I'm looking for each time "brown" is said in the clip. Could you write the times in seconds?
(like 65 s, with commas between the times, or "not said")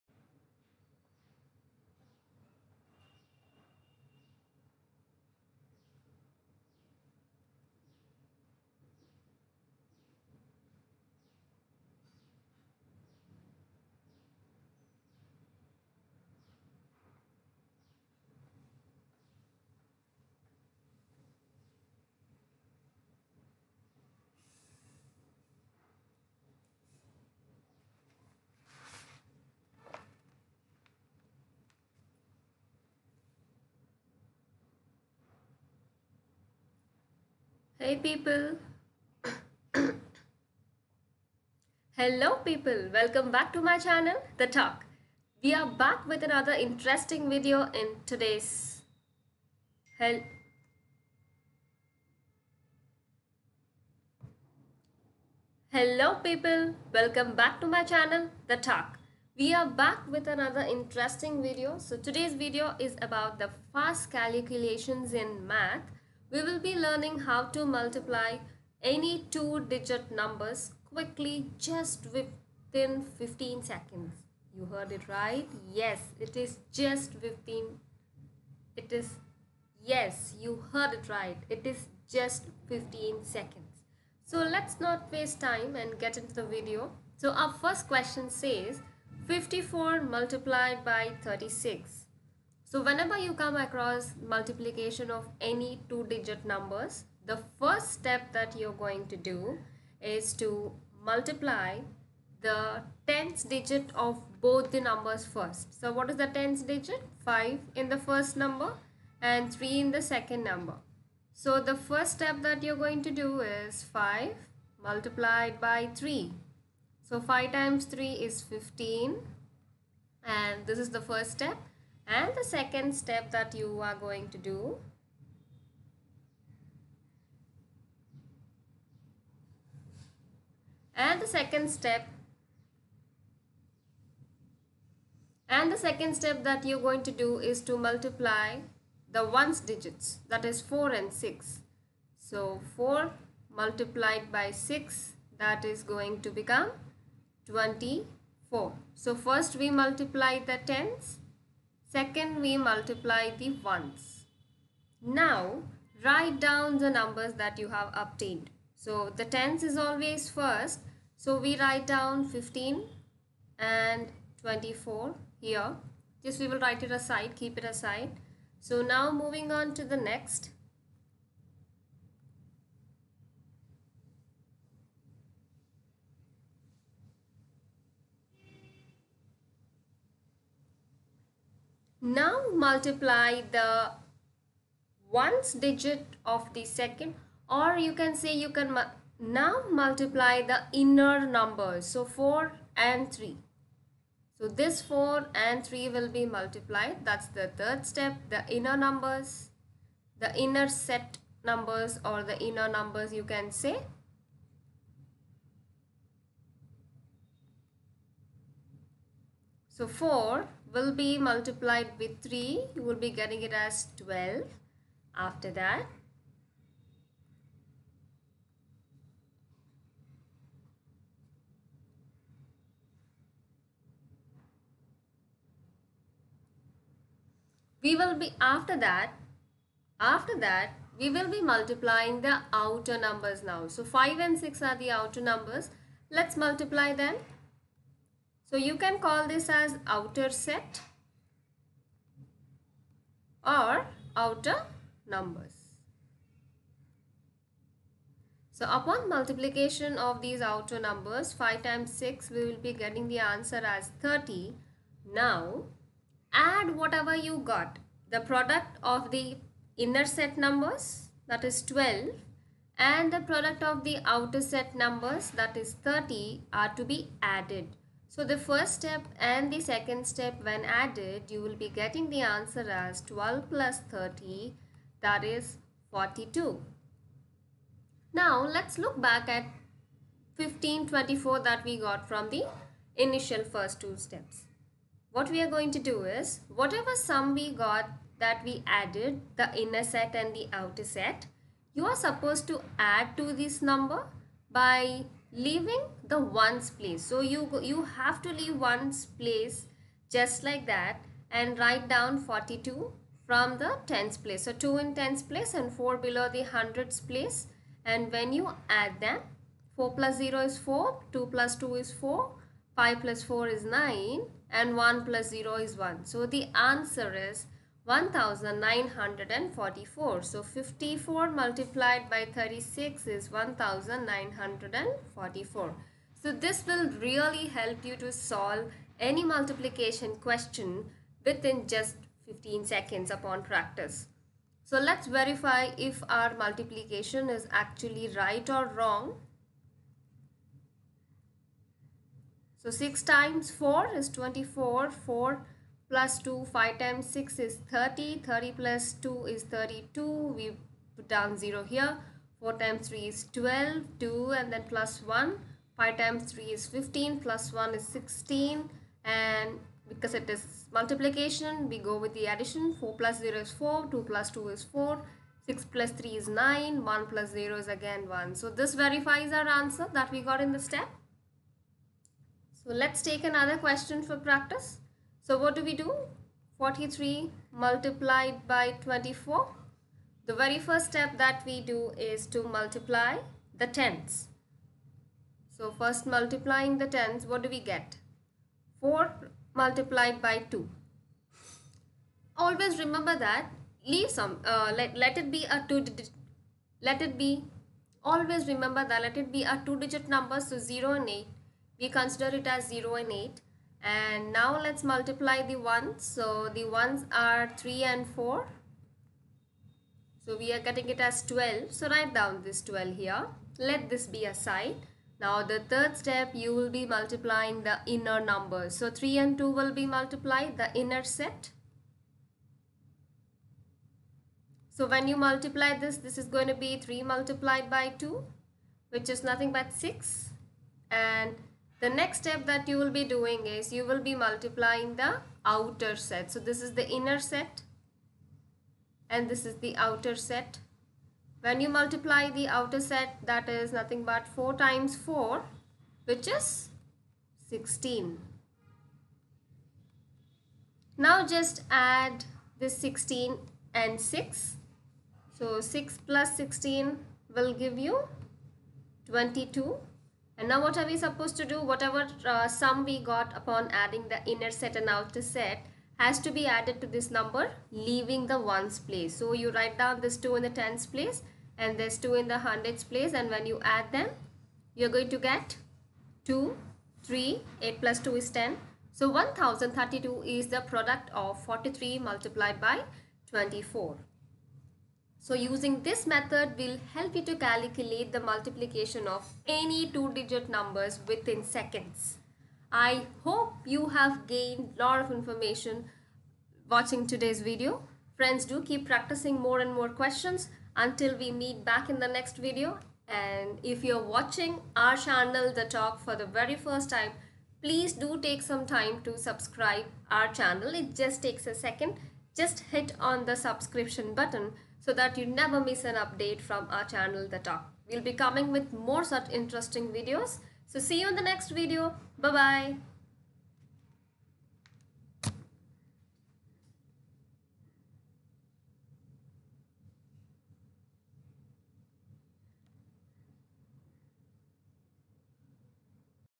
not said.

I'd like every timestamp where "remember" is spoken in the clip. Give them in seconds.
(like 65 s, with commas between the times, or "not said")
392 s, 398 s.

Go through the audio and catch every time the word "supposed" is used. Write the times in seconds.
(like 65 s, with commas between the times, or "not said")
291 s, 460 s.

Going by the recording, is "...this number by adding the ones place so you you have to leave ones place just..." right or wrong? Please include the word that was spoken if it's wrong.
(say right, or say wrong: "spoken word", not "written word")
wrong: "leaving", not "adding".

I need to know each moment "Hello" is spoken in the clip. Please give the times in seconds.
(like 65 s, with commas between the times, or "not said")
41 s, 49 s.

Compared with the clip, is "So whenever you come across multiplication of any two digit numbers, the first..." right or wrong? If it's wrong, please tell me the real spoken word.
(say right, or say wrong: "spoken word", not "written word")
right.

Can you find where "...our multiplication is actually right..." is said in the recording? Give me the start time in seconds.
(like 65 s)
336 s.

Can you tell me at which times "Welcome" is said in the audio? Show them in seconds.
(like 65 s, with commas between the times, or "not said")
42 s, 56 s.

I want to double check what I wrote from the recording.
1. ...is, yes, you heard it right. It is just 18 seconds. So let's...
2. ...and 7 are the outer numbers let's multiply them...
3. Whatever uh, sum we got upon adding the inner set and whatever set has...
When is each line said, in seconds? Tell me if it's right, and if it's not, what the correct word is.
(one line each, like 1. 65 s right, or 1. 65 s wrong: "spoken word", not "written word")
1. 78 s wrong: "15", not "18"
2. 234 s wrong: "6", not "7"
3. 461 s wrong: "outer", not "whatever".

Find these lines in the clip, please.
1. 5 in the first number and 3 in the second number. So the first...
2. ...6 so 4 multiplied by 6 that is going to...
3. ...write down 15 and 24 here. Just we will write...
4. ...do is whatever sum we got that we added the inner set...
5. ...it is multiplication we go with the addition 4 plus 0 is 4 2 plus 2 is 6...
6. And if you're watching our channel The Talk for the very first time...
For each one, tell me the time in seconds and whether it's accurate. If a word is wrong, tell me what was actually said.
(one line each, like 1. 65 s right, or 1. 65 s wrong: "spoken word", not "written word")
1. 107 s right
2. 141 s right
3. 161 s right
4. 285 s right
5. 360 s wrong: "4", not "6"
6. 503 s right.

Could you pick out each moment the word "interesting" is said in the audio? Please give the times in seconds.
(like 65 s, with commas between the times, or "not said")
46 s, 60 s, 519 s.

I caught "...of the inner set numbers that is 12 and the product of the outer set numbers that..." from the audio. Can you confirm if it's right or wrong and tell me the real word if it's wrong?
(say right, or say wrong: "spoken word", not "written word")
right.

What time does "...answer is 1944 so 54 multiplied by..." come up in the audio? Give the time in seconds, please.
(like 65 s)
316 s.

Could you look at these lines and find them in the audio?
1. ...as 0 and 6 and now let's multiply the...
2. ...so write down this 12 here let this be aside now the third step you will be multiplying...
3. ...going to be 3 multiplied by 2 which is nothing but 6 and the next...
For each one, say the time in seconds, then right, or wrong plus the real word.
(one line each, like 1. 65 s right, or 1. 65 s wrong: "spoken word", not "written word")
1. 402 s wrong: "8", not "6"
2. 411 s right
3. 426 s right.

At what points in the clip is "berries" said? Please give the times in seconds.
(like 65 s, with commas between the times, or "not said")
not said.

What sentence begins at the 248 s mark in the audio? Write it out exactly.
So upon multiplication of these outer numbers 5 times 6 we will be getting the answer as 30.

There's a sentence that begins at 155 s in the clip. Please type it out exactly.
Now, write down the numbers that you have obtained.